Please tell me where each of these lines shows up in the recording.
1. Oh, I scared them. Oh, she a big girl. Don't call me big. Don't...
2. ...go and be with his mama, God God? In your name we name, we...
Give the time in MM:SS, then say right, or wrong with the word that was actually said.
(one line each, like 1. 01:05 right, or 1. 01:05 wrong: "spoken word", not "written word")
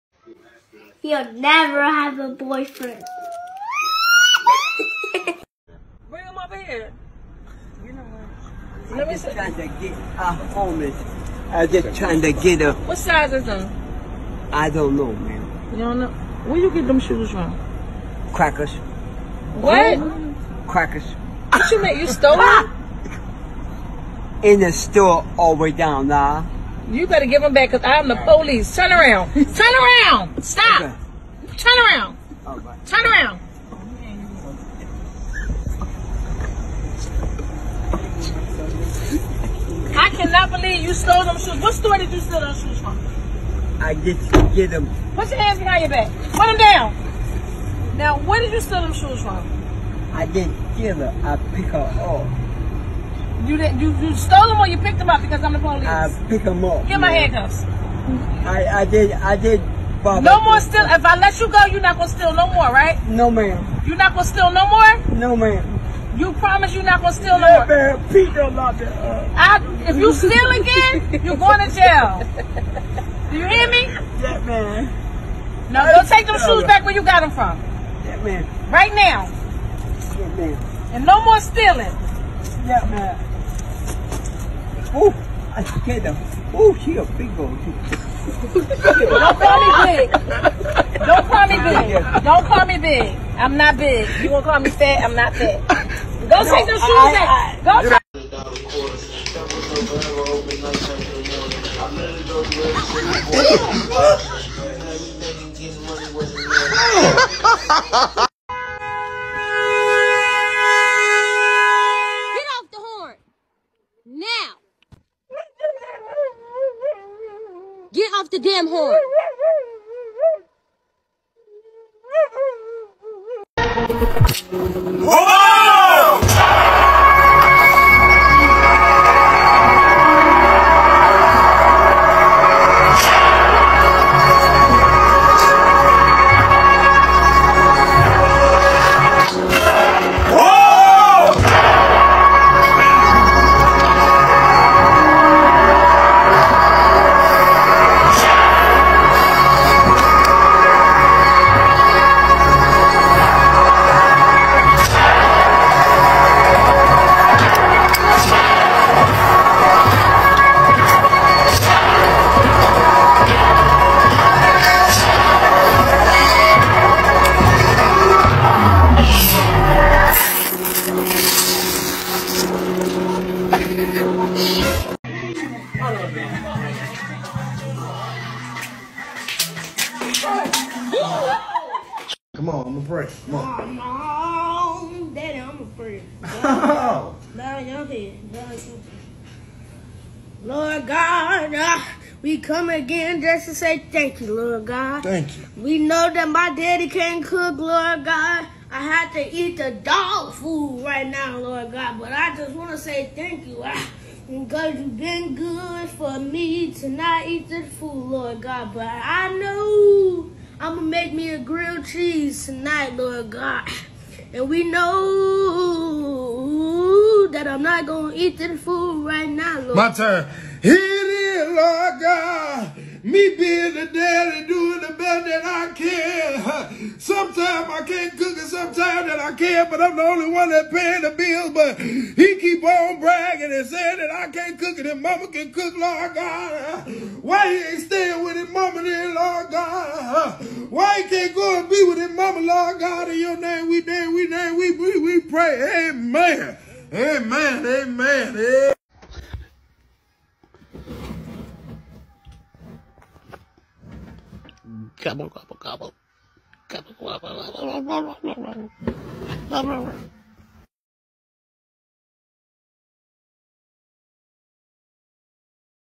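1. 01:24 right
2. 04:01 wrong: "Lord", not "God".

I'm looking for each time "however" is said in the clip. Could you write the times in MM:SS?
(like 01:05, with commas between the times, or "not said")
not said.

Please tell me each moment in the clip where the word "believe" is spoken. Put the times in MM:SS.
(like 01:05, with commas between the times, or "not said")
00:40.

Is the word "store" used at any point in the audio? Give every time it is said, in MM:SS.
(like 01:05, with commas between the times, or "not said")
00:24, 00:41.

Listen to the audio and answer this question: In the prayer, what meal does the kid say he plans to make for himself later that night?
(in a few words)
grilled cheese.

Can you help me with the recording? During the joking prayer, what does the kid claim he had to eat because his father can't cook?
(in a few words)
dog food.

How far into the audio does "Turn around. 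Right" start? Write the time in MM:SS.
00:31.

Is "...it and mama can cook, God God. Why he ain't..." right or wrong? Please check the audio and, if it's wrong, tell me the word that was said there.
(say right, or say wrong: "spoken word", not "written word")
wrong: "Lord", not "God".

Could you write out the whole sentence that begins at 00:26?
You better give them back because I'm the police.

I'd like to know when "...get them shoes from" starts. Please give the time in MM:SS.
00:16.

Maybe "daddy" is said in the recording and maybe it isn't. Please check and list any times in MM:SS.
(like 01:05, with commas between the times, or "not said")
03:05, 03:16, 03:43.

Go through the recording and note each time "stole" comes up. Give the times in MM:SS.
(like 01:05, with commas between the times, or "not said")
00:22, 00:40, 00:54.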